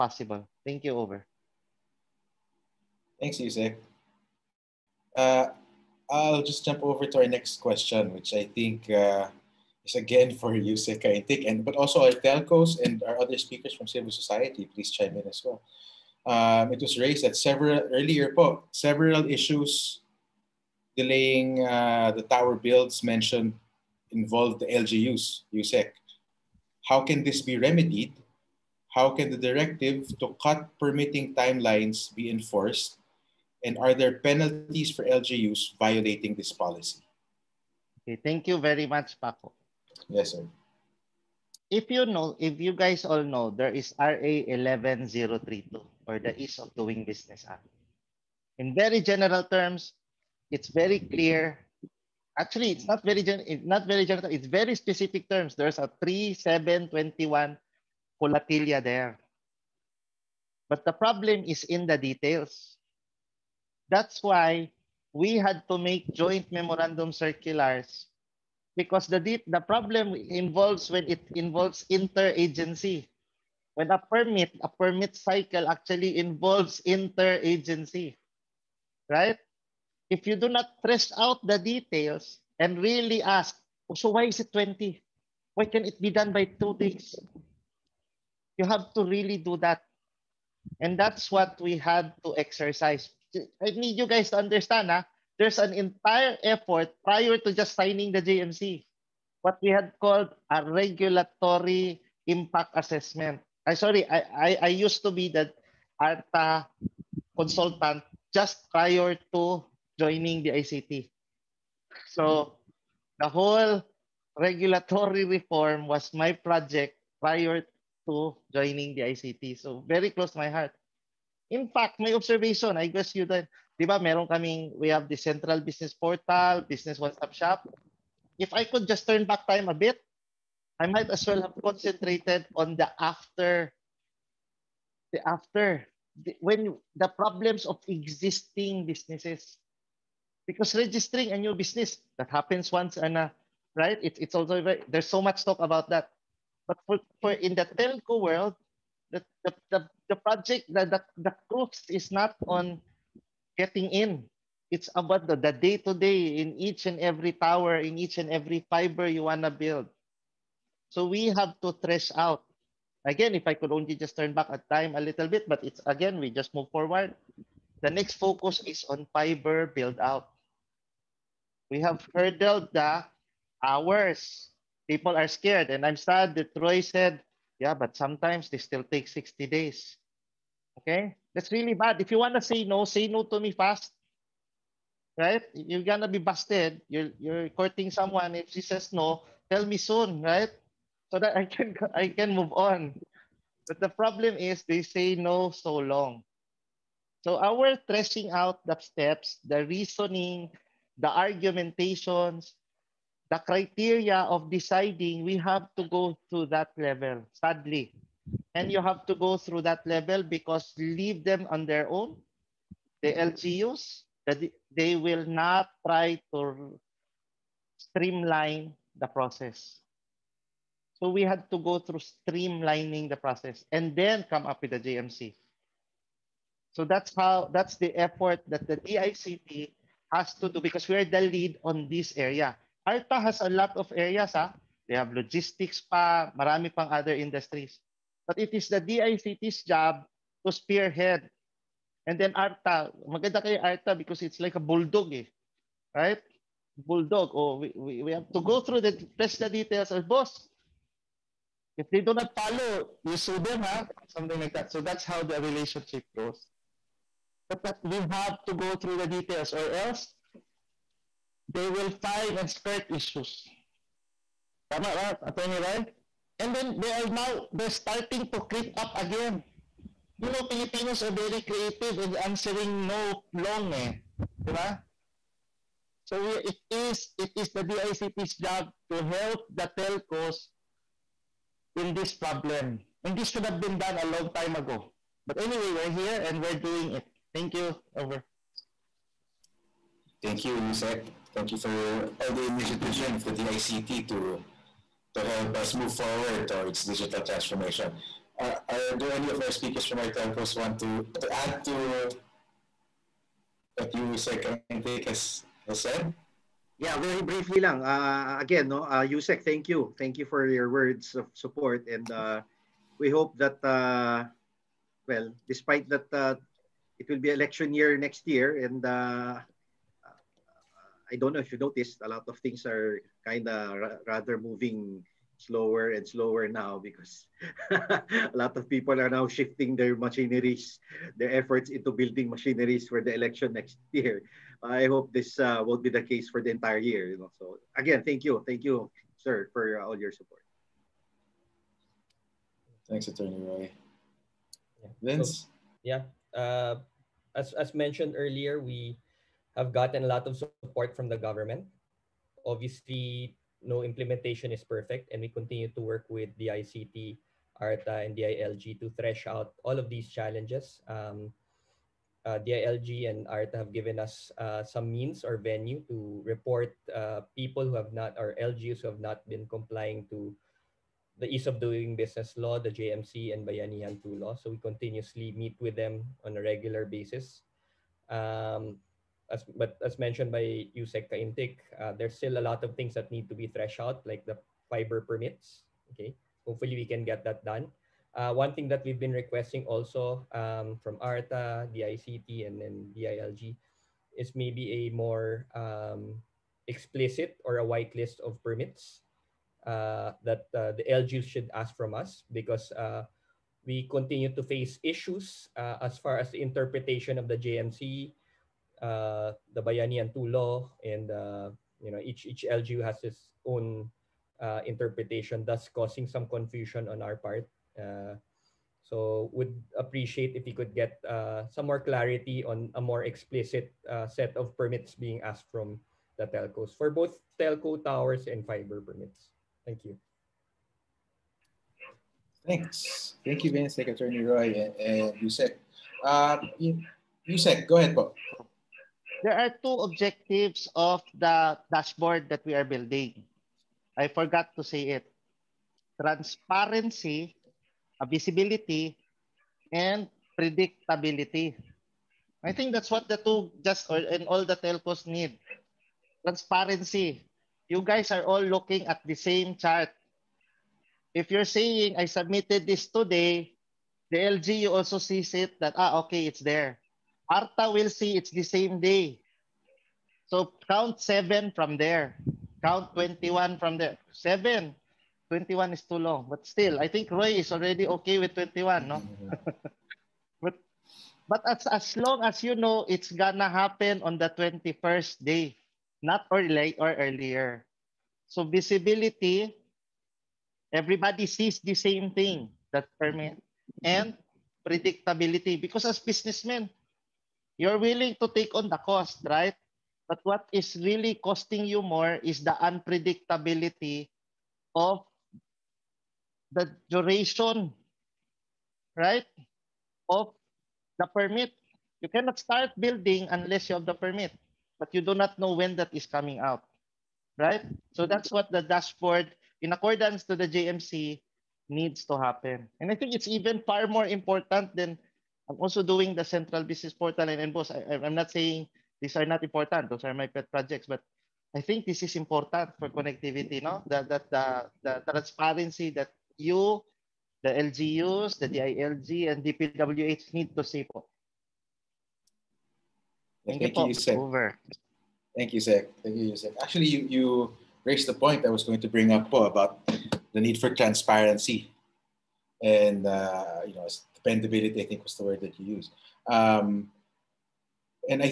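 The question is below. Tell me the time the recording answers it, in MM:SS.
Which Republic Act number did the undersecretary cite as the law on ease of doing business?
00:43.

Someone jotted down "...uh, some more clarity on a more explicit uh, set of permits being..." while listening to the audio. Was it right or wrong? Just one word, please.
right.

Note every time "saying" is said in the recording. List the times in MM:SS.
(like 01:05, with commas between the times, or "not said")
07:41, 08:48.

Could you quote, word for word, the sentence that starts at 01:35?
Ah, there's an entire effort prior to just signing the JMC, what we had called a regulatory impact assessment.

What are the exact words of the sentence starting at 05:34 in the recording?
I hope this uh, won't be the case for the entire year.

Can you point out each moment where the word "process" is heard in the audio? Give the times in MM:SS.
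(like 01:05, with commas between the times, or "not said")
03:39, 03:43.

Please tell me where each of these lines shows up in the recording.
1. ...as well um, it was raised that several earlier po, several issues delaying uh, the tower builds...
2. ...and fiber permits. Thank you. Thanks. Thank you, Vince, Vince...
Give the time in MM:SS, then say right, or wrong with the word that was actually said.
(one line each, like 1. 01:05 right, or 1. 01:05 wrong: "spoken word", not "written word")
1. 00:15 right
2. 07:08 wrong: "Secretary", not "Vince".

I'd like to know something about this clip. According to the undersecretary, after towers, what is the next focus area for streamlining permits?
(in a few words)
Fiber build out.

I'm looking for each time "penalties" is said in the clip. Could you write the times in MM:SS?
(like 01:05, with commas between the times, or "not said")
00:34.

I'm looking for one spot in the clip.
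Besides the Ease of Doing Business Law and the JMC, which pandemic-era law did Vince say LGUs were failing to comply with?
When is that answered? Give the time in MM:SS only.
06:13.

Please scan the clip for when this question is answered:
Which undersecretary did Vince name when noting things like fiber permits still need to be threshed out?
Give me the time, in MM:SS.
06:20.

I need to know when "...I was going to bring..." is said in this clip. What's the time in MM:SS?
09:08.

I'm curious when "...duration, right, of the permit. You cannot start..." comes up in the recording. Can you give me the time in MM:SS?
08:26.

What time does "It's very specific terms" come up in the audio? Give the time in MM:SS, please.
00:54.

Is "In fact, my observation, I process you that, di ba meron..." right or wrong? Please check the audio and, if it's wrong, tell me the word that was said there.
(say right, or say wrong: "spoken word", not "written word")
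wrong: "guess", not "process".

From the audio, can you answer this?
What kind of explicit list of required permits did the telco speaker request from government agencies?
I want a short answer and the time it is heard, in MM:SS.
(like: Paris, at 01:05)
White list, at 06:37.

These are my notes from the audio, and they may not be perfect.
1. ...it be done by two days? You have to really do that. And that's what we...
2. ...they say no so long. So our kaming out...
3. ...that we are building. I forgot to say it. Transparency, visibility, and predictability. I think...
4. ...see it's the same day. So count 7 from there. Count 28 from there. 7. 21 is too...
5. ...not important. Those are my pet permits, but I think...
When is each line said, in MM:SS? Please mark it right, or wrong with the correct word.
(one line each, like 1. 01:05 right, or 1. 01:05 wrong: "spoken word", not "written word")
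1. 01:25 right
2. 03:14 wrong: "threshing", not "kaming"
3. 07:22 right
4. 07:47 wrong: "21", not "28"
5. 08:49 wrong: "projects", not "permits".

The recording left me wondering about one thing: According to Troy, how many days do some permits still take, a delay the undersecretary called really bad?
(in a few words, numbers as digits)
60 days.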